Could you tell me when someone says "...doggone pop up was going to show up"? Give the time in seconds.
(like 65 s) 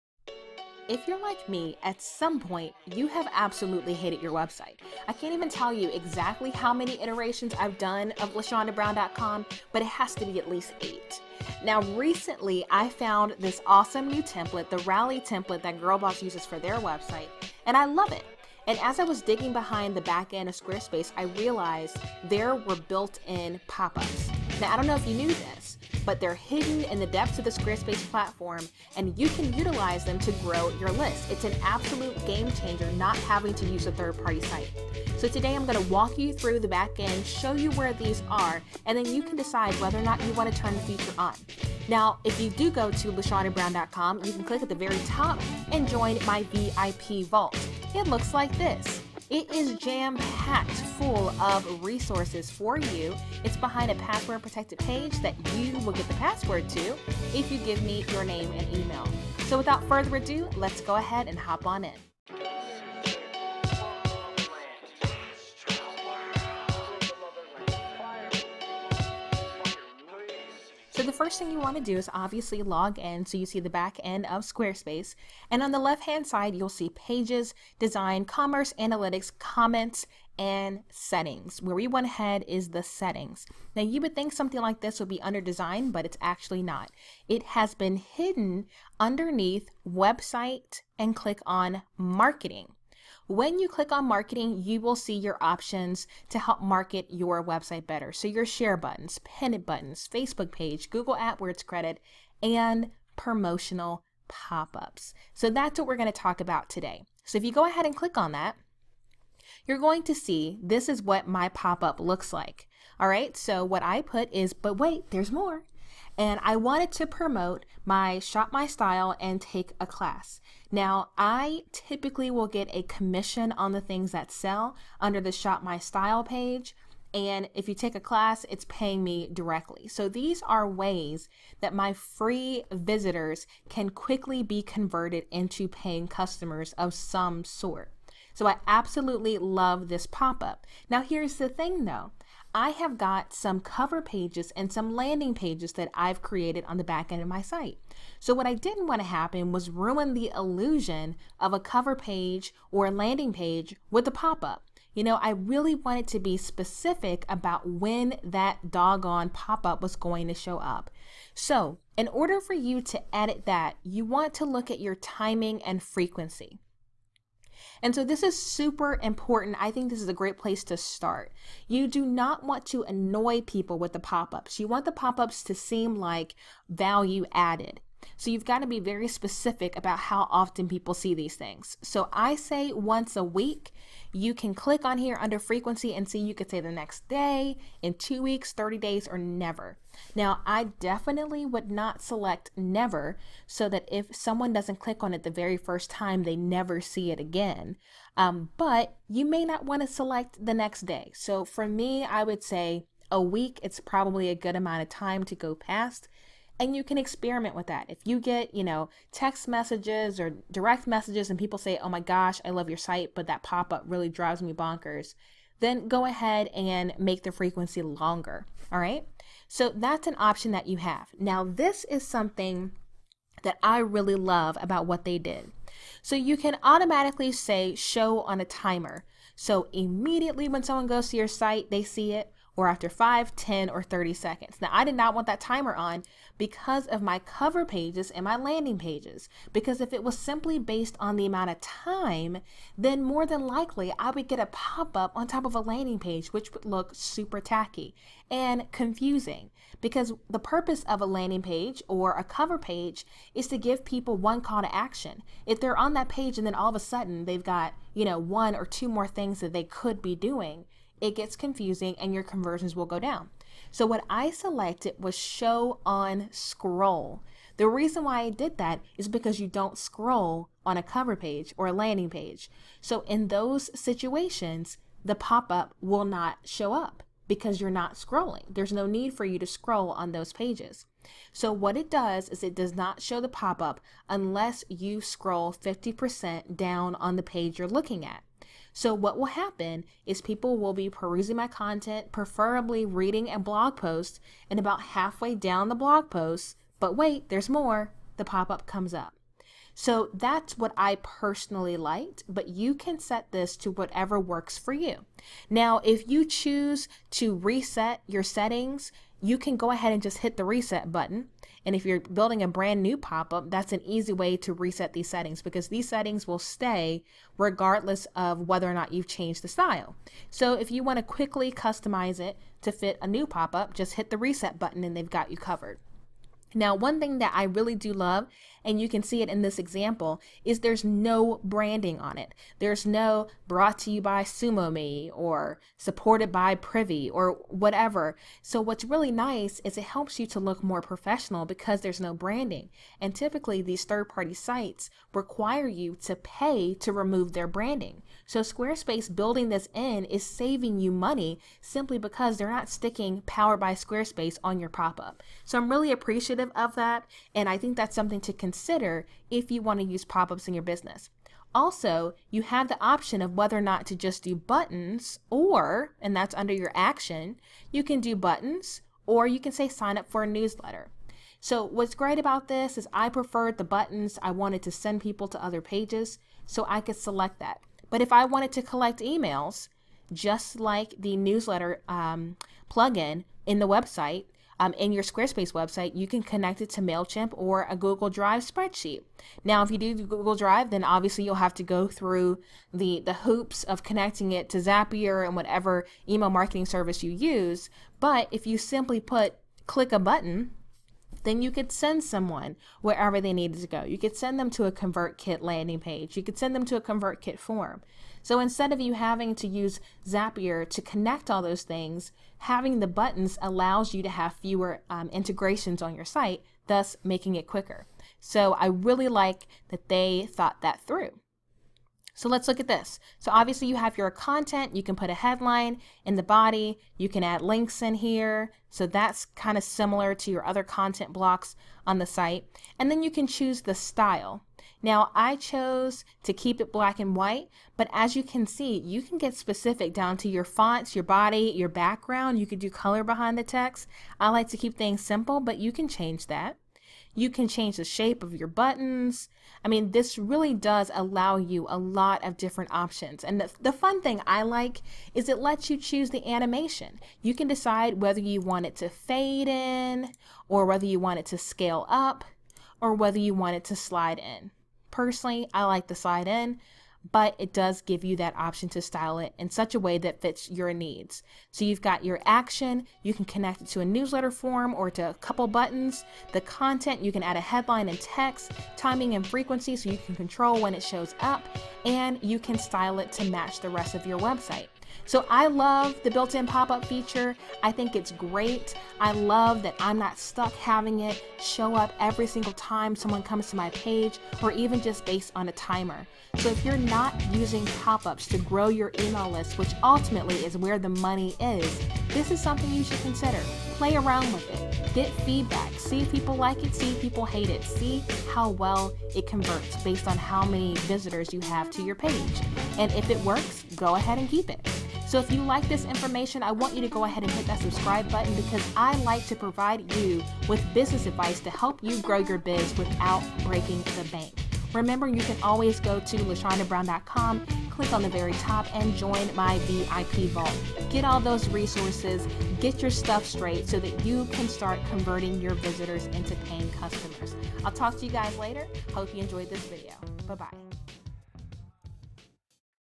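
158 s.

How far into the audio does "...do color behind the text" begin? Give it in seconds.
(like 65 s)
442 s.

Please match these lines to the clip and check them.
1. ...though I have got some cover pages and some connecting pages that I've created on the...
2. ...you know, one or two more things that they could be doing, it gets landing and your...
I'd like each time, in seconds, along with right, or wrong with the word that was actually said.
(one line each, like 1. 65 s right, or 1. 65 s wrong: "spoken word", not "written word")
1. 141 s wrong: "landing", not "connecting"
2. 257 s wrong: "confusing", not "landing".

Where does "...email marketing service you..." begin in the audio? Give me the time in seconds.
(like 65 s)
396 s.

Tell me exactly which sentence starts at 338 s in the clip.
So what's really nice is it helps you to look more professional because there's no branding.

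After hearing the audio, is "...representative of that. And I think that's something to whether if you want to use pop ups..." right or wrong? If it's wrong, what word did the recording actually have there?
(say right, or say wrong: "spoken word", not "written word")
wrong: "consider", not "whether".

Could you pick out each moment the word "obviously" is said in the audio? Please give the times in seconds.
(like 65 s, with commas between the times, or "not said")
72 s, 390 s, 423 s.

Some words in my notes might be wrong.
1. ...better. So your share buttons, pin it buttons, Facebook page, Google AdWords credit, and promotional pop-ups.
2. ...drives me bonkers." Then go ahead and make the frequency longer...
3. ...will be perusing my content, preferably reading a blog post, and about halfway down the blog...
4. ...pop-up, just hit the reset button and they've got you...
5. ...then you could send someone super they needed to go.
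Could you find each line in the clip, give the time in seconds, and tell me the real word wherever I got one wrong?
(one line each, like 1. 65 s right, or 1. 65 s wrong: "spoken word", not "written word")
1. 97 s right
2. 214 s right
3. 290 s right
4. 323 s right
5. 401 s wrong: "wherever", not "super".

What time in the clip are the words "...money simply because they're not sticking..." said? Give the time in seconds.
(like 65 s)
350 s.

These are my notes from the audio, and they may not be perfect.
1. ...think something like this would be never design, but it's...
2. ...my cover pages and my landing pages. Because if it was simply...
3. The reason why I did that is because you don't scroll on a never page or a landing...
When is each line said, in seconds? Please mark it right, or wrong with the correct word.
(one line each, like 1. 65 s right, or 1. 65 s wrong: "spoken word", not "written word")
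1. 84 s wrong: "under", not "never"
2. 237 s right
3. 267 s wrong: "cover", not "never".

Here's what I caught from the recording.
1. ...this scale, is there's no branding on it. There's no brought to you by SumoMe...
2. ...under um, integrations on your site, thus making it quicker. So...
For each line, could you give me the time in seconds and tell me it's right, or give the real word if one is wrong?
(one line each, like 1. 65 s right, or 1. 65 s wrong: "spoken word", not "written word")
1. 329 s wrong: "example", not "scale"
2. 414 s wrong: "fewer", not "under".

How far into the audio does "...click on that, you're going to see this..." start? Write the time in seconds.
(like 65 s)
107 s.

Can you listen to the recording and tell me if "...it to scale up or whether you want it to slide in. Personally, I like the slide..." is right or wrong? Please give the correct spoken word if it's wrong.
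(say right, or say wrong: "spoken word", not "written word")
right.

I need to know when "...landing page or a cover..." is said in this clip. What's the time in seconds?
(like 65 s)
251 s.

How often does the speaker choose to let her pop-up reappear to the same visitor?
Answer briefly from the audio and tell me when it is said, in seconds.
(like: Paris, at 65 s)
Once a week, at 182 s.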